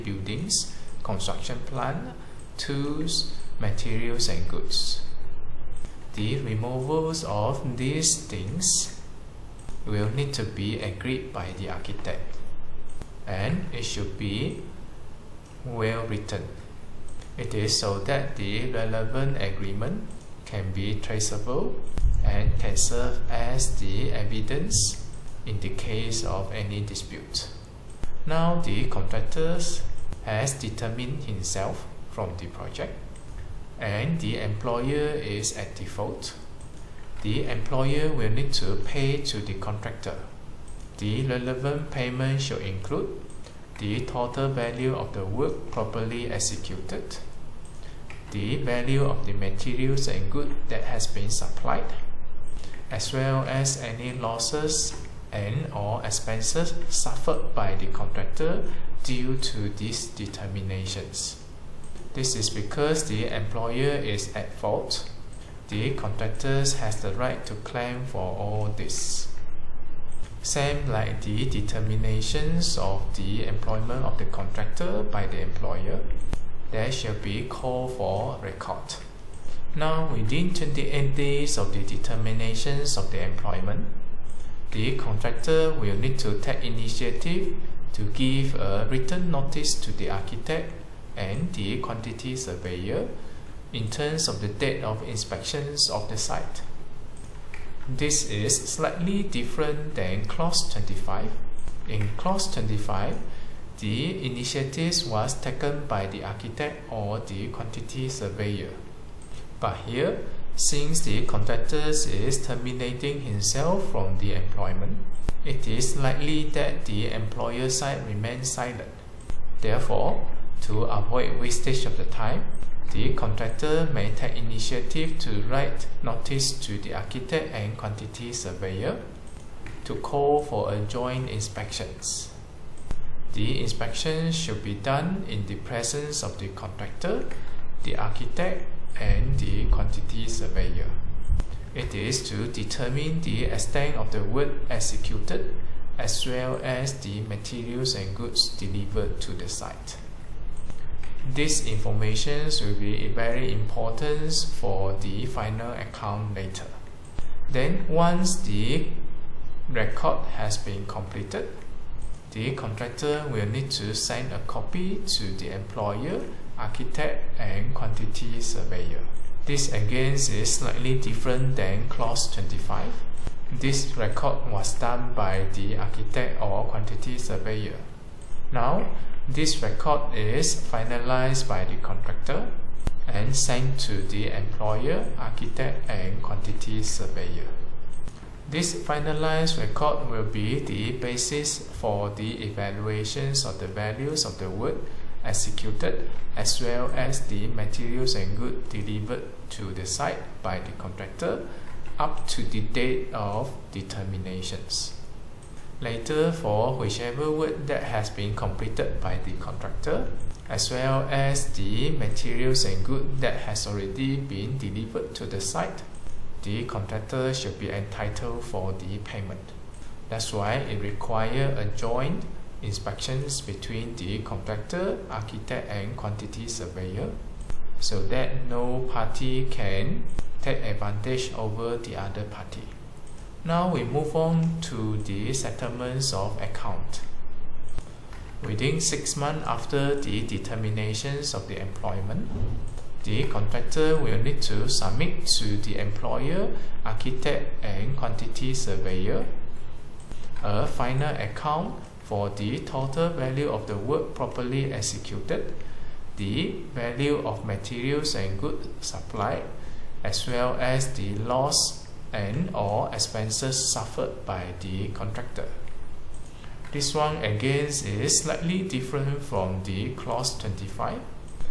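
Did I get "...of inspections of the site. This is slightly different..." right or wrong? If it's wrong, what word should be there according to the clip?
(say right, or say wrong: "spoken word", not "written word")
right.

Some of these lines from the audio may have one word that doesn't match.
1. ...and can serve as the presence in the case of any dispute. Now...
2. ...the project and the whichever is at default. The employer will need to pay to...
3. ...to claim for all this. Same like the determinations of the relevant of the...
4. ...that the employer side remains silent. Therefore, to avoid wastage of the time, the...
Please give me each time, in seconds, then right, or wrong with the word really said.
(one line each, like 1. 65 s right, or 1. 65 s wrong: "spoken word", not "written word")
1. 22 s wrong: "evidence", not "presence"
2. 32 s wrong: "employer", not "whichever"
3. 67 s wrong: "employment", not "relevant"
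4. 116 s right.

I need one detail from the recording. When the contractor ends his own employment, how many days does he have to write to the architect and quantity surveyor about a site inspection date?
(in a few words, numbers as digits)
28 days.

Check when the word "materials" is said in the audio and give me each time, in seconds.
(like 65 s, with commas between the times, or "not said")
3 s, 49 s, 147 s, 197 s, 211 s, 257 s.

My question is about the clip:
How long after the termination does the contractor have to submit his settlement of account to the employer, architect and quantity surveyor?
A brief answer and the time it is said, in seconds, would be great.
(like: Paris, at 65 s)
6 months, at 238 s.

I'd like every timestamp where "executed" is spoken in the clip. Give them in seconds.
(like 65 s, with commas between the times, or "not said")
46 s, 144 s, 195 s, 254 s.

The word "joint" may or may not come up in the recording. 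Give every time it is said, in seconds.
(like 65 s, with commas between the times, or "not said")
130 s, 221 s.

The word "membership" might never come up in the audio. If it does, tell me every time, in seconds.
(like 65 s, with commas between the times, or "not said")
not said.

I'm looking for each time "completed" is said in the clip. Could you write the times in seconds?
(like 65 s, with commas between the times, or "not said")
160 s, 208 s.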